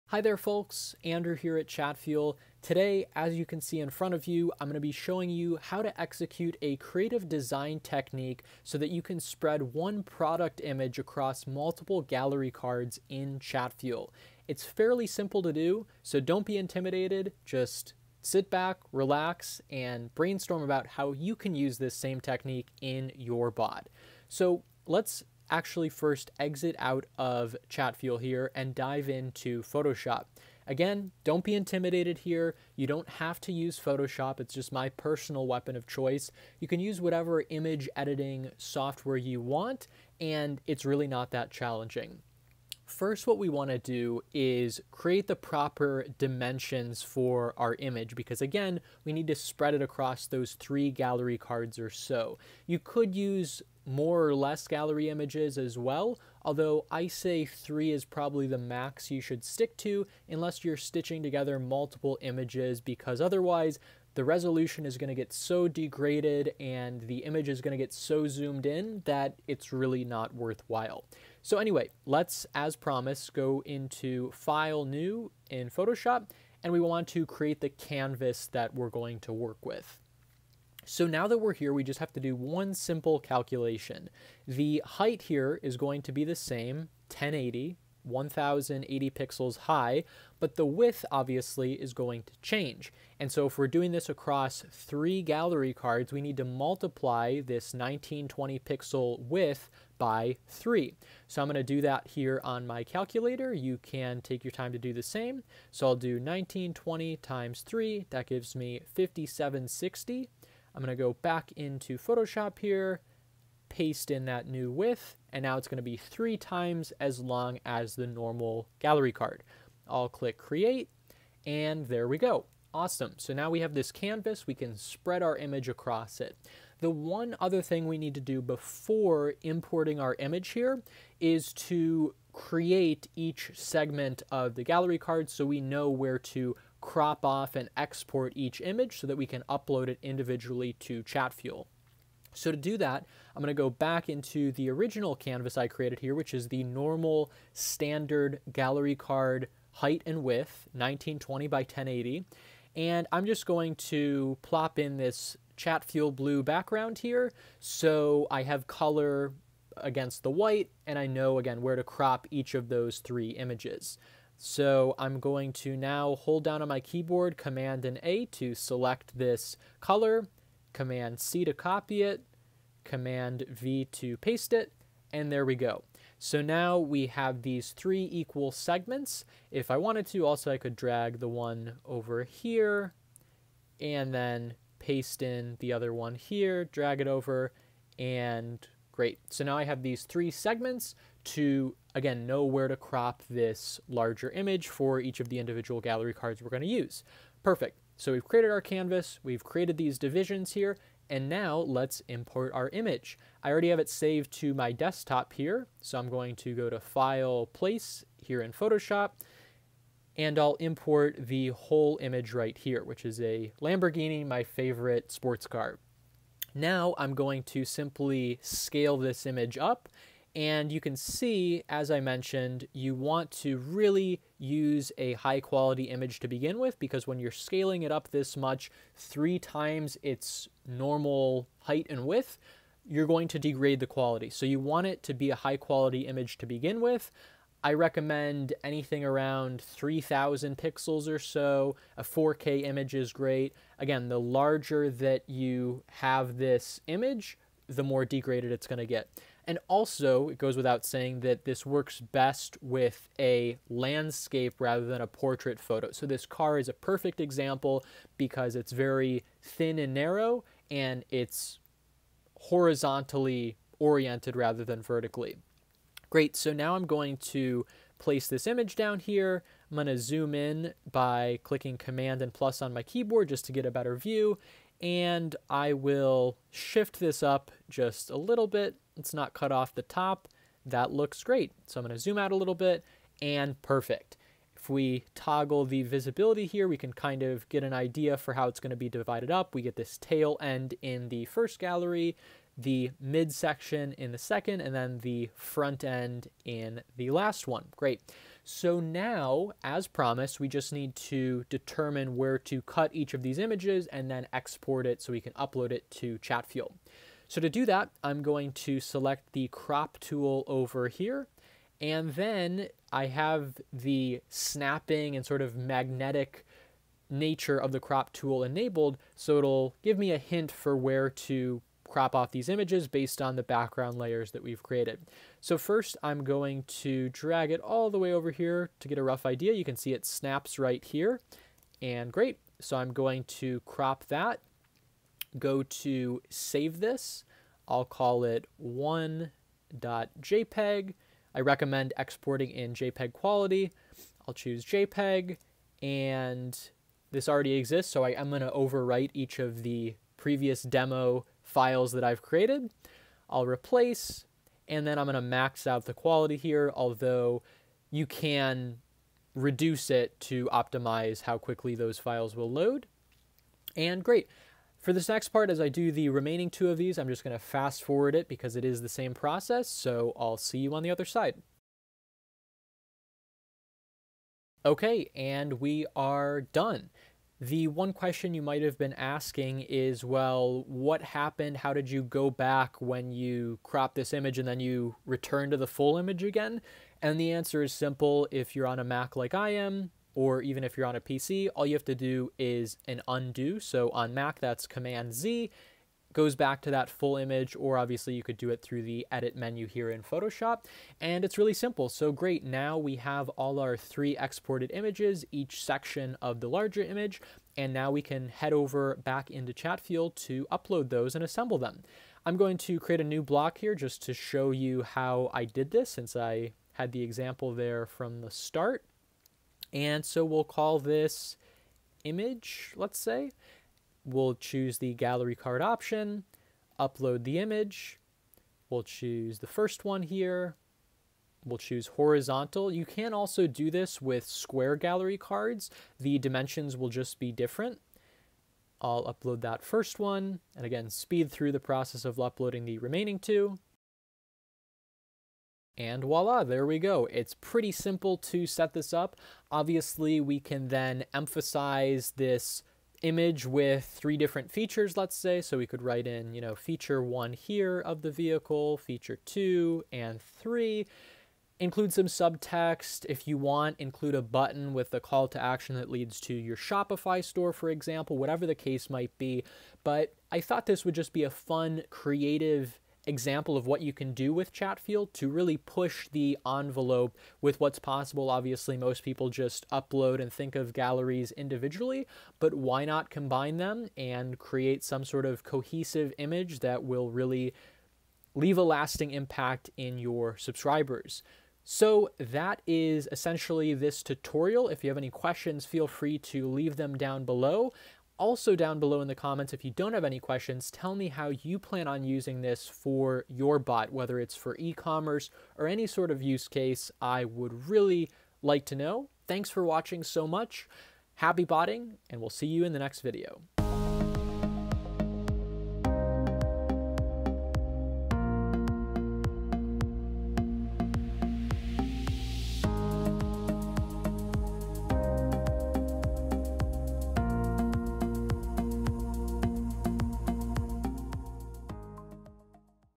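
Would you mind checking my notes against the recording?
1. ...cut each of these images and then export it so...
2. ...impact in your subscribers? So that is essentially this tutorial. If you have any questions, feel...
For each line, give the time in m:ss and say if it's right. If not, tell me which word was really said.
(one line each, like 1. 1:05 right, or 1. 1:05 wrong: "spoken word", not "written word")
1. 5:02 right
2. 8:09 right.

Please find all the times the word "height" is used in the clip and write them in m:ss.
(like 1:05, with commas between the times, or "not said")
1:24, 2:29, 3:51.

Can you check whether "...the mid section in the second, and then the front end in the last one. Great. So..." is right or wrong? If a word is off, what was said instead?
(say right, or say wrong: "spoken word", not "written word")
right.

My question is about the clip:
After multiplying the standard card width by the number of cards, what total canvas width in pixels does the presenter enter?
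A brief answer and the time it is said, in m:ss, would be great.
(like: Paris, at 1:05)
5760, at 1:48.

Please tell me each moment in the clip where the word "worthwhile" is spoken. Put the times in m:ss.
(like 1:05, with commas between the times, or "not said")
1:10.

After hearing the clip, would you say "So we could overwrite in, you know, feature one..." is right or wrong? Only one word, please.
wrong.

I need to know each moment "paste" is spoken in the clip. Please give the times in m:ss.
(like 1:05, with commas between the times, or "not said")
1:53, 2:54, 3:04.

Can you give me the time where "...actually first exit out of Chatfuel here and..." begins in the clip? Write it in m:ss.
0:25.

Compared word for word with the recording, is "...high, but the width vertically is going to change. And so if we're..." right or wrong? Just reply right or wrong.
wrong.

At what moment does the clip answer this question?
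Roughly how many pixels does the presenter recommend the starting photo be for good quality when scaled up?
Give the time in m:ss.
3:59.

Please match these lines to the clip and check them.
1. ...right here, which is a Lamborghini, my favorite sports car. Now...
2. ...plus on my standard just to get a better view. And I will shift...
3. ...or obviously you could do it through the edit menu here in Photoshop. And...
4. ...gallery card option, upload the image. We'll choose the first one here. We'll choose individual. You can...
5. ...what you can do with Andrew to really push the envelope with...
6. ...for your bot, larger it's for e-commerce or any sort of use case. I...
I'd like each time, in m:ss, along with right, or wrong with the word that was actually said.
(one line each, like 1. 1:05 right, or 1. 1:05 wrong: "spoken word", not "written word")
1. 3:32 right
2. 4:32 wrong: "keyboard", not "standard"
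3. 6:37 right
4. 7:04 wrong: "horizontal", not "individual"
5. 7:53 wrong: "Chatfuel", not "Andrew"
6. 8:22 wrong: "whether", not "larger".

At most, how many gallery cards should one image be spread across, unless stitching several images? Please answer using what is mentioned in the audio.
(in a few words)
3.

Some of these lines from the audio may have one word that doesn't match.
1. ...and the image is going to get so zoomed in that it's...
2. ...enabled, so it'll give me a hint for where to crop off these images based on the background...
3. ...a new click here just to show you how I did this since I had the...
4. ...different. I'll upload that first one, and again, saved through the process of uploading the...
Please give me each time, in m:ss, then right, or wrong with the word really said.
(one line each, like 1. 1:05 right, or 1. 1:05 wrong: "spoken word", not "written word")
1. 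1:06 right
2. 5:18 right
3. 6:53 wrong: "block", not "click"
4. 7:17 wrong: "speed", not "saved".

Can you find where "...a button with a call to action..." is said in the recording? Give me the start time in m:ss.
7:44.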